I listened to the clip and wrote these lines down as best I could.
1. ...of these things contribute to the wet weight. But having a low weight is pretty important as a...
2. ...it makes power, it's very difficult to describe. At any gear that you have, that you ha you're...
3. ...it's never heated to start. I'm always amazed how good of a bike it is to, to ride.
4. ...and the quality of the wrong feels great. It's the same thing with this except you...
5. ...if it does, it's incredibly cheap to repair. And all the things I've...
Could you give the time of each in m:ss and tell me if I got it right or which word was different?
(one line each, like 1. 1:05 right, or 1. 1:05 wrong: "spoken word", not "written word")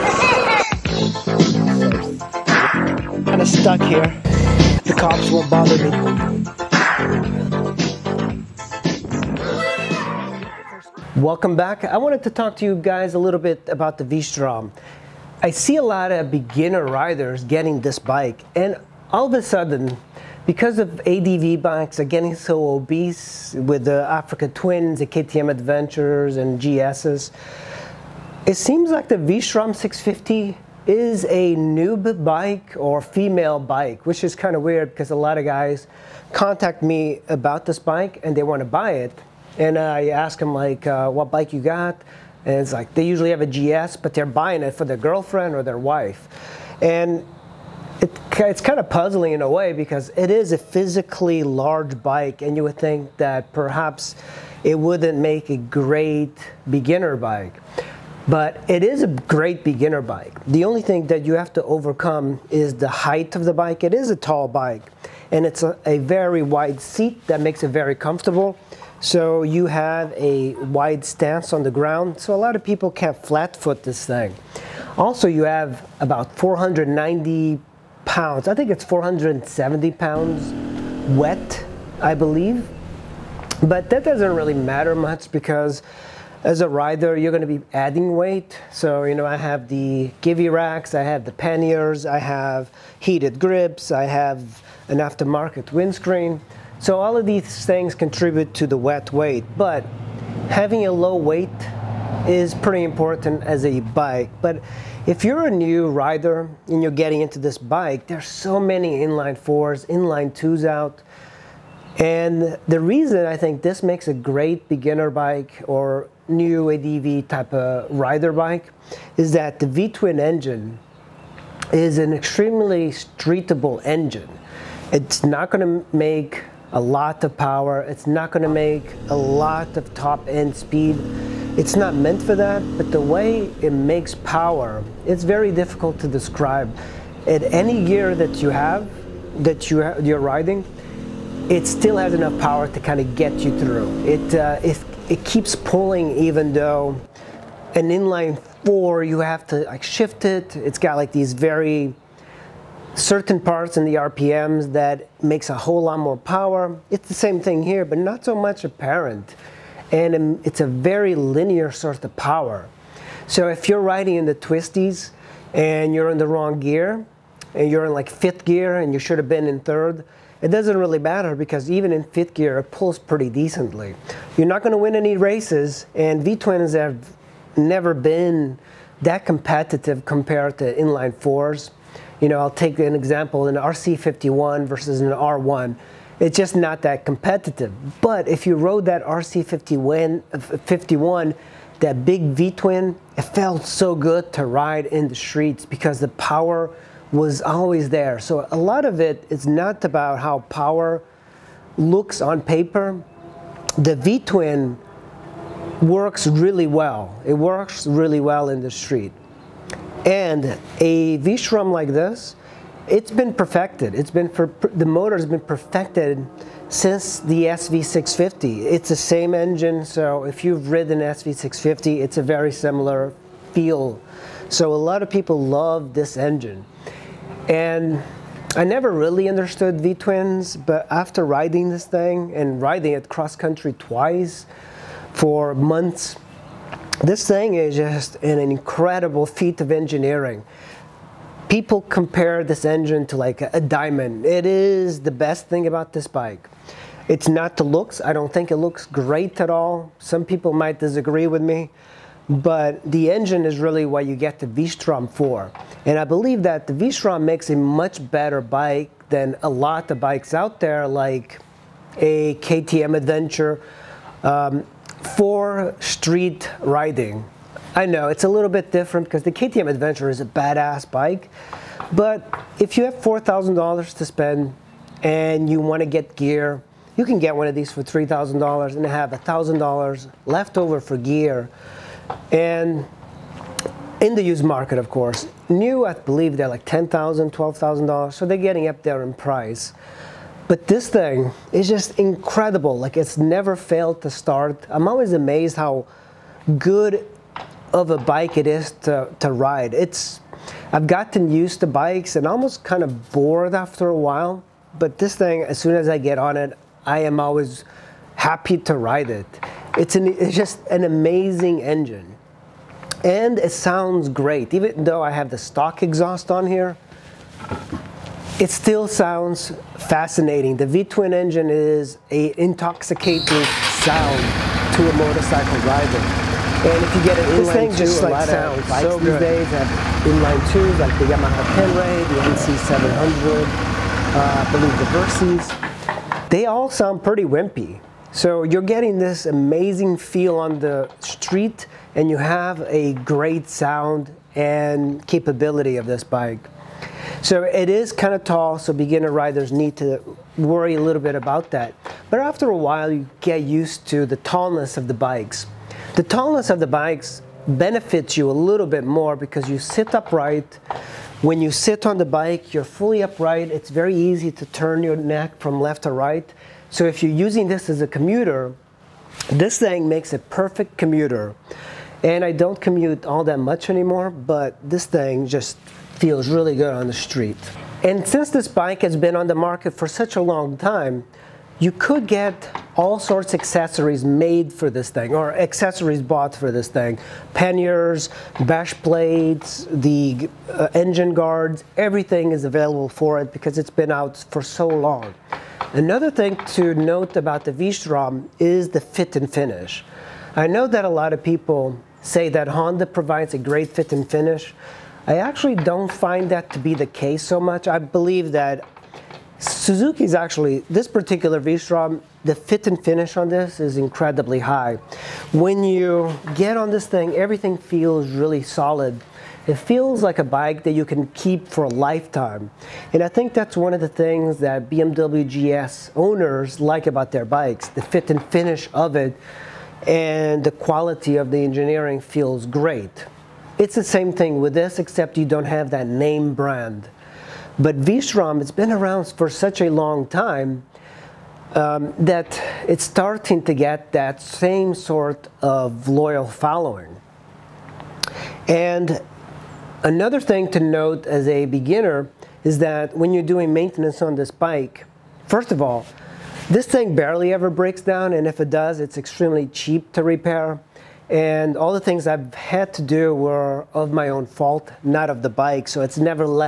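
1. 1:37 right
2. 2:13 right
3. 4:52 wrong: "failed", not "heated"
4. 7:09 wrong: "engineering", not "wrong"
5. 7:38 wrong: "extremely", not "incredibly".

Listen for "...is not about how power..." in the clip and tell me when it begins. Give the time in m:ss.
3:19.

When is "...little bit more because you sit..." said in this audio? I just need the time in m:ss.
5:58.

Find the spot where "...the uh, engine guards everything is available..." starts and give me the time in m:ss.
6:29.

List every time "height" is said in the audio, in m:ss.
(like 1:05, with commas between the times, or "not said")
1:02.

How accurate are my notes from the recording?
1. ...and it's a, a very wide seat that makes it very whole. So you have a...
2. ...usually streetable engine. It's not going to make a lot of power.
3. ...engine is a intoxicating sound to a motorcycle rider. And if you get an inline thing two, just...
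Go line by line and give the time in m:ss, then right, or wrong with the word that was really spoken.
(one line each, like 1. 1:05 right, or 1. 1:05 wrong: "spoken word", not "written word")
1. 1:05 wrong: "comfortable", not "whole"
2. 2:02 wrong: "extremely", not "usually"
3. 5:21 right.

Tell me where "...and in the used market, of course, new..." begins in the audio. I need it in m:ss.
4:42.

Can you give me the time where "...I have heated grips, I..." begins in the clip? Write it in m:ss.
1:32.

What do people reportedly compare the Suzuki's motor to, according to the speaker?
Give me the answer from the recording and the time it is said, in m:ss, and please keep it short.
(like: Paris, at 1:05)
a diamond, at 4:03.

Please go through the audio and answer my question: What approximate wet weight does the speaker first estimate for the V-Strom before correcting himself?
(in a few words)
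490 pounds.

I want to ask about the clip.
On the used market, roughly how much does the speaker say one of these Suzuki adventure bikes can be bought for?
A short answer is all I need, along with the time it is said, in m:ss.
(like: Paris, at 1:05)
$3,000, at 4:37.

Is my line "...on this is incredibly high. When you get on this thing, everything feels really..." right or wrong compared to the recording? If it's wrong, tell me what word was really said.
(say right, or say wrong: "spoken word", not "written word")
right.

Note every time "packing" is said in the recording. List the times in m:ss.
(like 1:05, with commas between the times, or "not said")
not said.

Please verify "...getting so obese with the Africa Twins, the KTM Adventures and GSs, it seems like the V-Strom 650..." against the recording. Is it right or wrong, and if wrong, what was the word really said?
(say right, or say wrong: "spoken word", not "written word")
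right.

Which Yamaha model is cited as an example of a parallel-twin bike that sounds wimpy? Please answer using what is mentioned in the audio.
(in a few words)
Ténéré.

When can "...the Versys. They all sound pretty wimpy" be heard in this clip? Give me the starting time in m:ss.
5:34.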